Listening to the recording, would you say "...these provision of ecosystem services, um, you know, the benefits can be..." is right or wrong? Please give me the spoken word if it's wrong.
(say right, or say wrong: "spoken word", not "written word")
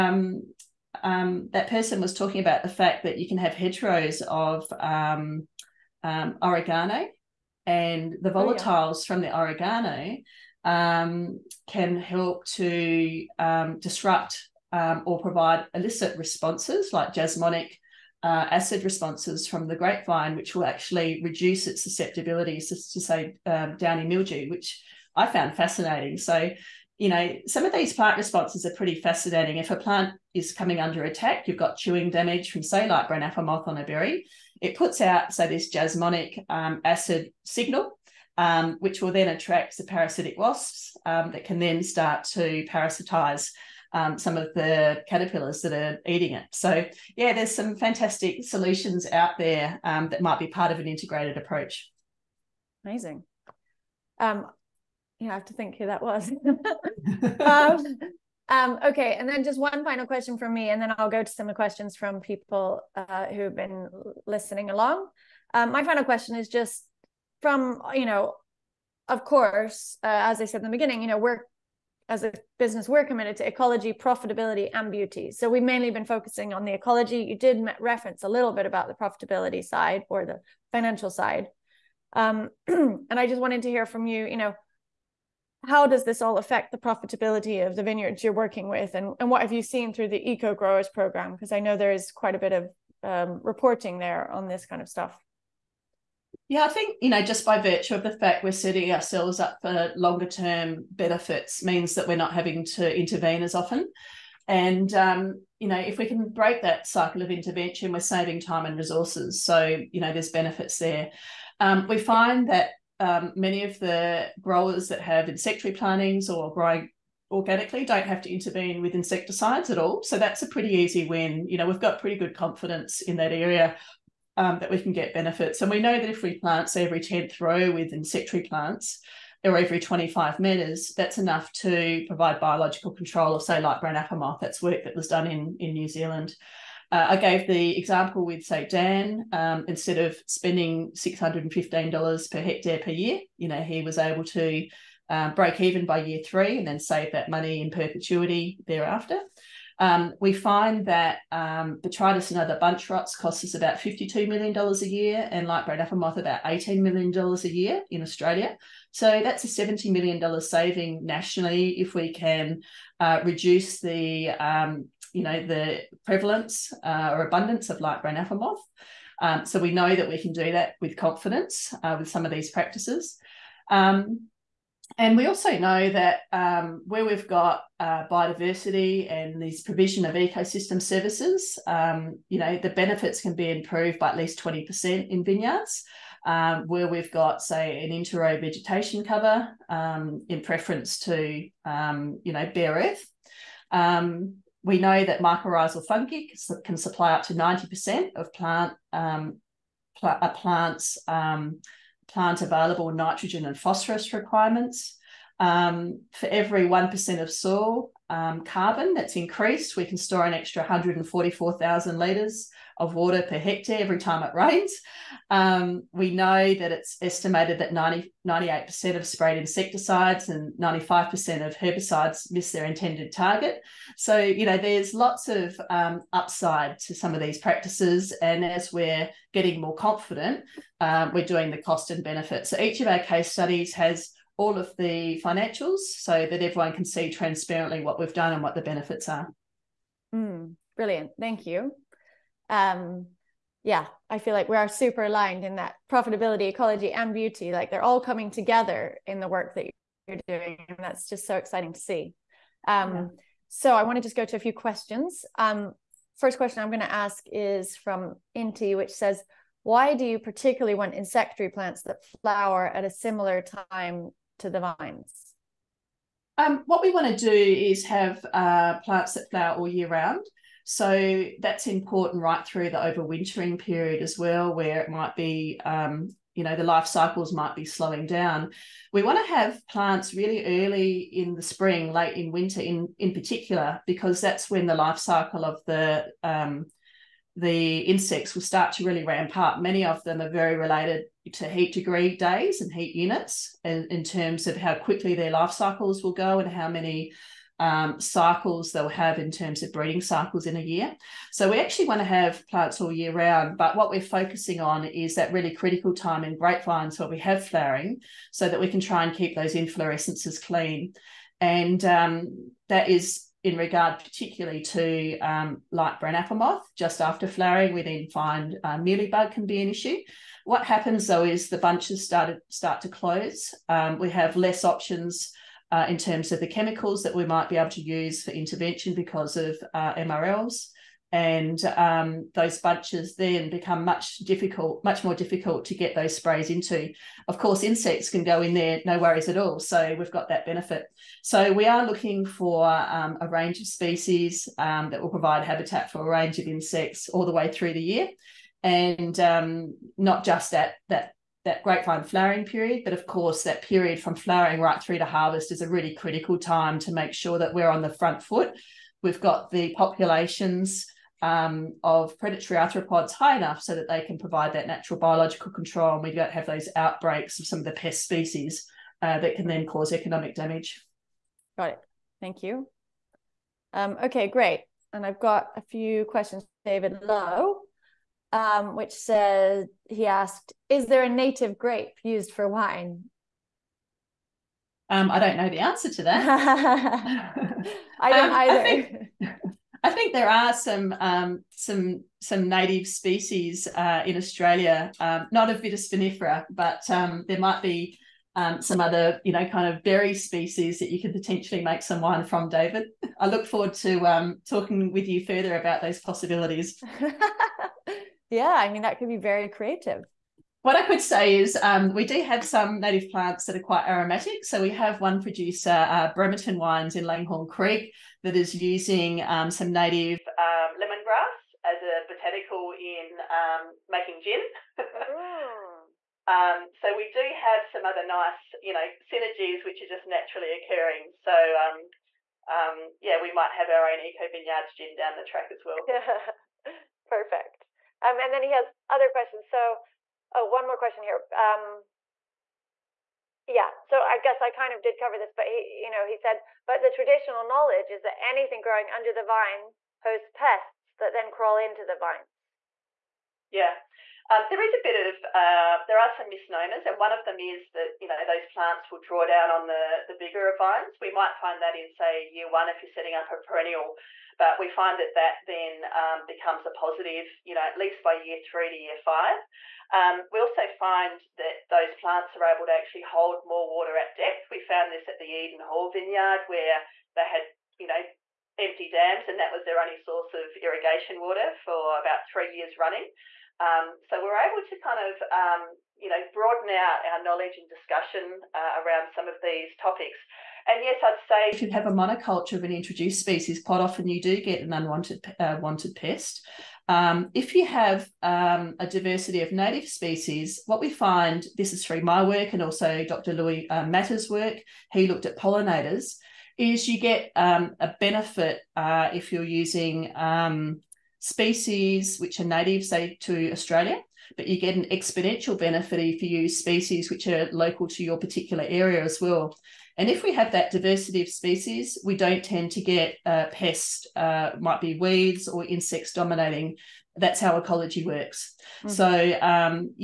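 right.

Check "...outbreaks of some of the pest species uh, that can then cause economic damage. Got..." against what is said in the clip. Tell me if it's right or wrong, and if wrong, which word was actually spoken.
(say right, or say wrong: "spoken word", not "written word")
right.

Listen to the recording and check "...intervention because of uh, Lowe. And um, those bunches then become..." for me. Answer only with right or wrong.
wrong.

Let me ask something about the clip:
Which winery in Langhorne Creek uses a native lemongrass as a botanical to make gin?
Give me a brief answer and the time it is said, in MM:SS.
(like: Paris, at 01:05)
Bremerton Wines, at 06:56.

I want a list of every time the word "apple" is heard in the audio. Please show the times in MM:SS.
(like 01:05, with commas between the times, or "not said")
00:33, 02:13, 02:35, 02:48, 05:16.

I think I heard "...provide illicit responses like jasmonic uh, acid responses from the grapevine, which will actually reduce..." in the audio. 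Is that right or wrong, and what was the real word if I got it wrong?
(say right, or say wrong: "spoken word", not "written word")
right.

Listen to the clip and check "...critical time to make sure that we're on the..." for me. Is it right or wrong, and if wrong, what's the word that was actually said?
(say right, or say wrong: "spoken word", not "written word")
right.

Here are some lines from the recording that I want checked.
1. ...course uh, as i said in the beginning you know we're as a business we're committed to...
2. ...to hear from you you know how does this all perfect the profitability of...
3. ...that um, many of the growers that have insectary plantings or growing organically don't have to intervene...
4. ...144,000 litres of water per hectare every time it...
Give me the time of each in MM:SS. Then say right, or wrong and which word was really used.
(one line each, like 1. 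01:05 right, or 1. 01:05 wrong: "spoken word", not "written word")
1. 01:09 right
2. 01:23 wrong: "affect", not "perfect"
3. 01:52 right
4. 03:30 right.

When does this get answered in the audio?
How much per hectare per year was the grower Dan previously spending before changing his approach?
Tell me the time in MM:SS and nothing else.
02:20.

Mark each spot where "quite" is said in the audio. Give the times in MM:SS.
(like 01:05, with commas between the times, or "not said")
01:32, 06:53, 08:13.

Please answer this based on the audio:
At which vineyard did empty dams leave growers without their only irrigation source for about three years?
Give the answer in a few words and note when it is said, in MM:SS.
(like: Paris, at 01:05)
Eden Hall, at 07:55.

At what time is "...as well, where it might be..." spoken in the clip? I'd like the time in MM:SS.
04:34.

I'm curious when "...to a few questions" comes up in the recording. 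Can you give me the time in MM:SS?
04:14.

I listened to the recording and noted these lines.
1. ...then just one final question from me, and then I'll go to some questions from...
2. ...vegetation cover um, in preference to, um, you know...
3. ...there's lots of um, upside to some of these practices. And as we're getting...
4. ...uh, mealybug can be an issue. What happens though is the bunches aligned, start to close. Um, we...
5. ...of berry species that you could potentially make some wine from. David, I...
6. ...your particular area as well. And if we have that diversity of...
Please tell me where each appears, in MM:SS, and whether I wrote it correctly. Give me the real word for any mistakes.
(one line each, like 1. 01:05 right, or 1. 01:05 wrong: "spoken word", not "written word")
1. 00:59 right
2. 03:08 right
3. 03:44 right
4. 05:18 wrong: "started", not "aligned"
5. 06:39 right
6. 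08:38 right.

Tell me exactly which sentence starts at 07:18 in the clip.
Um, and then he has other questions.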